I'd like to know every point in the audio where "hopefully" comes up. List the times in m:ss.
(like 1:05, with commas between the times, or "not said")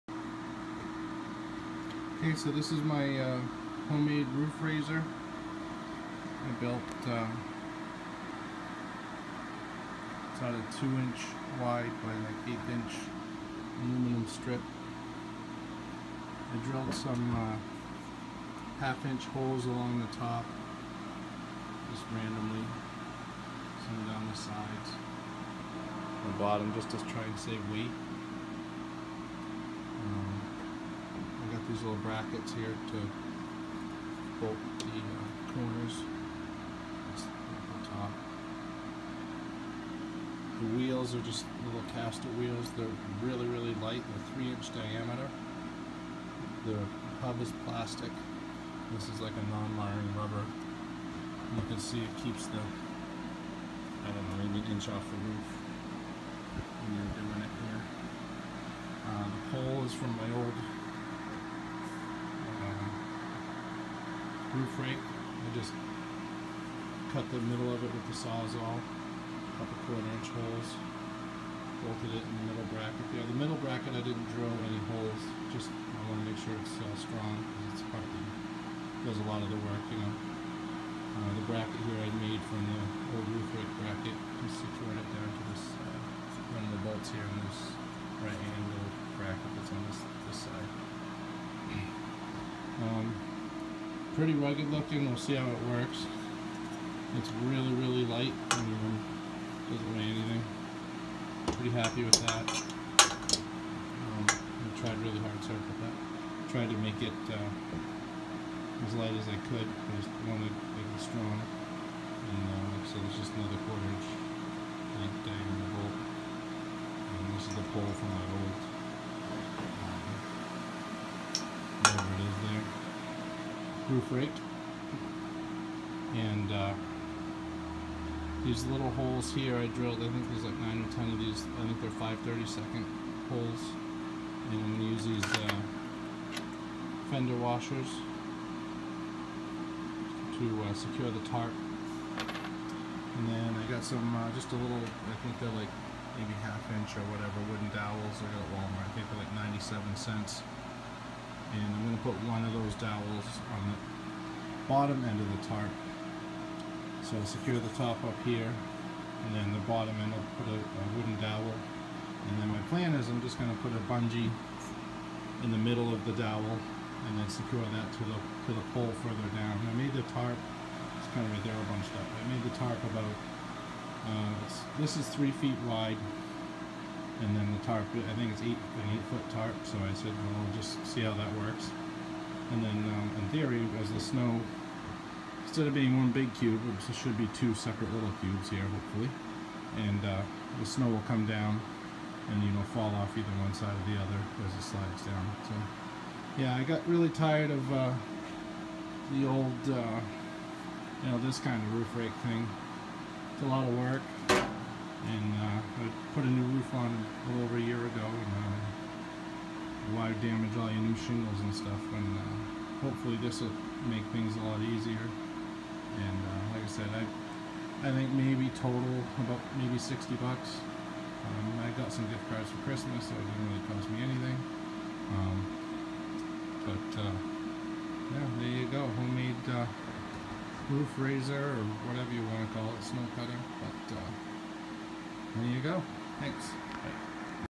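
3:08, 3:32.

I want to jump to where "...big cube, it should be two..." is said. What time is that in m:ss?
3:06.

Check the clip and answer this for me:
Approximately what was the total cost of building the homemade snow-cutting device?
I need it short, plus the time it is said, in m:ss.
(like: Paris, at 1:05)
$60, at 3:39.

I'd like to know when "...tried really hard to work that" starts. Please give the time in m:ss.
1:44.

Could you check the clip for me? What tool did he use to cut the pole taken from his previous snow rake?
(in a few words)
sawzall.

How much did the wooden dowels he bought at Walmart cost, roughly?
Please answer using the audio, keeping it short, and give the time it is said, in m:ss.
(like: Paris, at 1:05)
97 cents, at 2:29.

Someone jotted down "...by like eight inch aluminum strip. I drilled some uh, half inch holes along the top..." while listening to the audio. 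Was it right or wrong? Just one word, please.
right.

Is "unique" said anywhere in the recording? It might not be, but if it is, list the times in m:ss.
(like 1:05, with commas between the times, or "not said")
not said.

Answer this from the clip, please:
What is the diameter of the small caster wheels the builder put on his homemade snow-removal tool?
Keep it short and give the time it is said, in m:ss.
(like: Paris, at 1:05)
3 inches, at 0:44.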